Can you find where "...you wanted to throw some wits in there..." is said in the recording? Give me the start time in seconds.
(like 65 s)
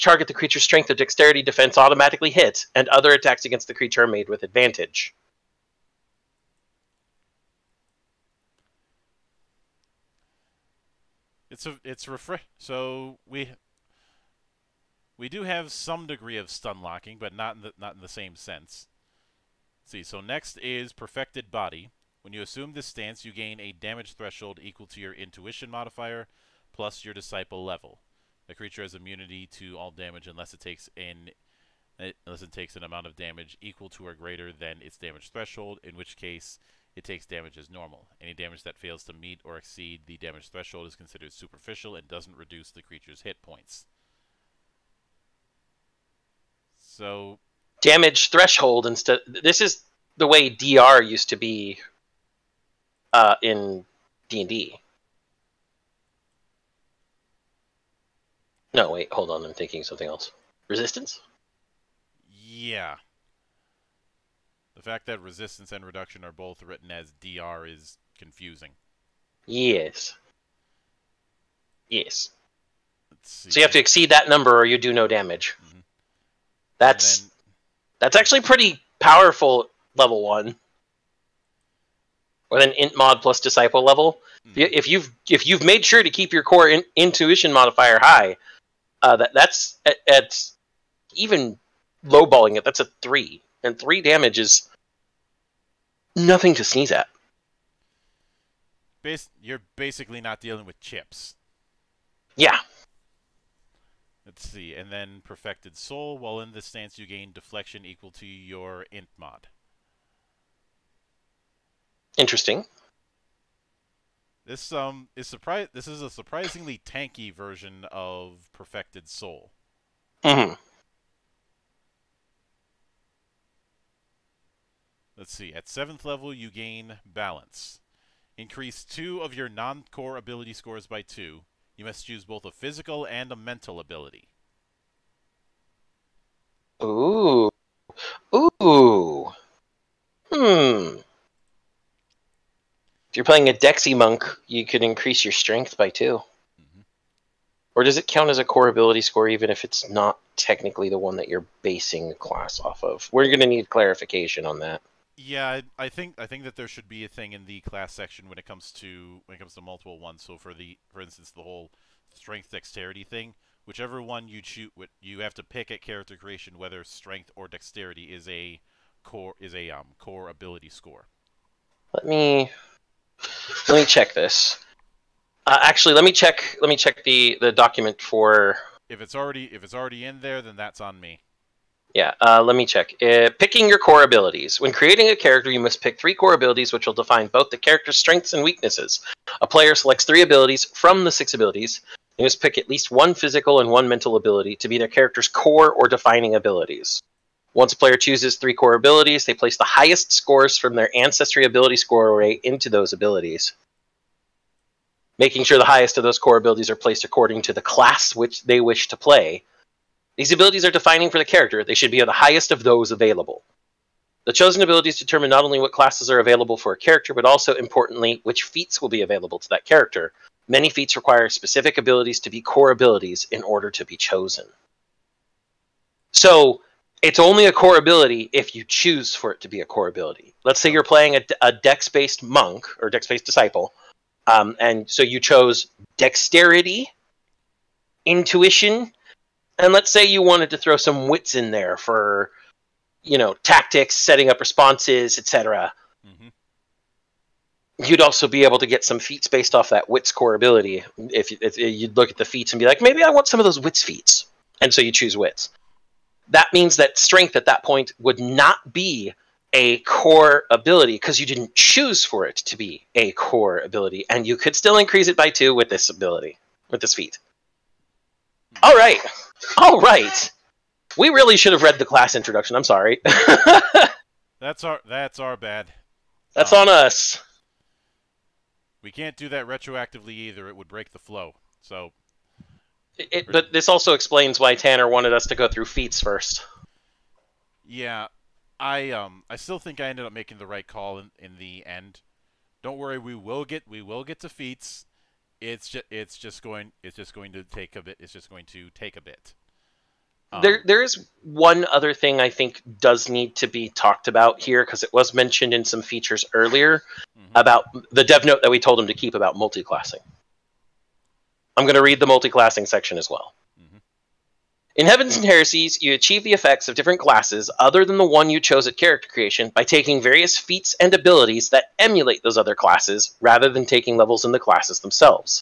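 240 s.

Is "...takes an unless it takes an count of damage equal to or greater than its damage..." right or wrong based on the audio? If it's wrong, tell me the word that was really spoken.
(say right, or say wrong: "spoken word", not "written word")
wrong: "amount", not "count".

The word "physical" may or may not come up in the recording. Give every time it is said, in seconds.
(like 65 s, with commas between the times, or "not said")
132 s, 193 s.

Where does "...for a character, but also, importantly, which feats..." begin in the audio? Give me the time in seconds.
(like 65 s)
216 s.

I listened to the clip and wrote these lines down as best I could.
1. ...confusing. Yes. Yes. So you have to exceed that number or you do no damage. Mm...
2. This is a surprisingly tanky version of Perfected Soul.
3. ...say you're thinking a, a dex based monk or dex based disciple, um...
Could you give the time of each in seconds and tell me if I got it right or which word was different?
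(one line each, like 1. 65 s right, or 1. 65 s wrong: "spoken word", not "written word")
1. 68 s right
2. 115 s right
3. 230 s wrong: "playing", not "thinking".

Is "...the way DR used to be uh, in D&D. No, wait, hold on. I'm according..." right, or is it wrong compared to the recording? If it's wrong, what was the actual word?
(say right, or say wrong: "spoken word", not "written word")
wrong: "thinking", not "according".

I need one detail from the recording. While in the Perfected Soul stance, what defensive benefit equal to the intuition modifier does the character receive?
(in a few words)
deflection.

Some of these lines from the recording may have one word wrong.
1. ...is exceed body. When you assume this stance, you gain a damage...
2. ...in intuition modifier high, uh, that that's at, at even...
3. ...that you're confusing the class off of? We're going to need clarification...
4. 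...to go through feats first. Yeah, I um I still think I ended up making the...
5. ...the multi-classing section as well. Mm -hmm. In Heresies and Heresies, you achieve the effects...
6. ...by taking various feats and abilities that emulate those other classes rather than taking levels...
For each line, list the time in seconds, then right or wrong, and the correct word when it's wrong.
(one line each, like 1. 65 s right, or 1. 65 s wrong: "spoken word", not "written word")
1. 20 s wrong: "perfected", not "exceed"
2. 86 s right
3. 151 s wrong: "basing", not "confusing"
4. 285 s right
5. 311 s wrong: "Heavens", not "Heresies"
6. 319 s right.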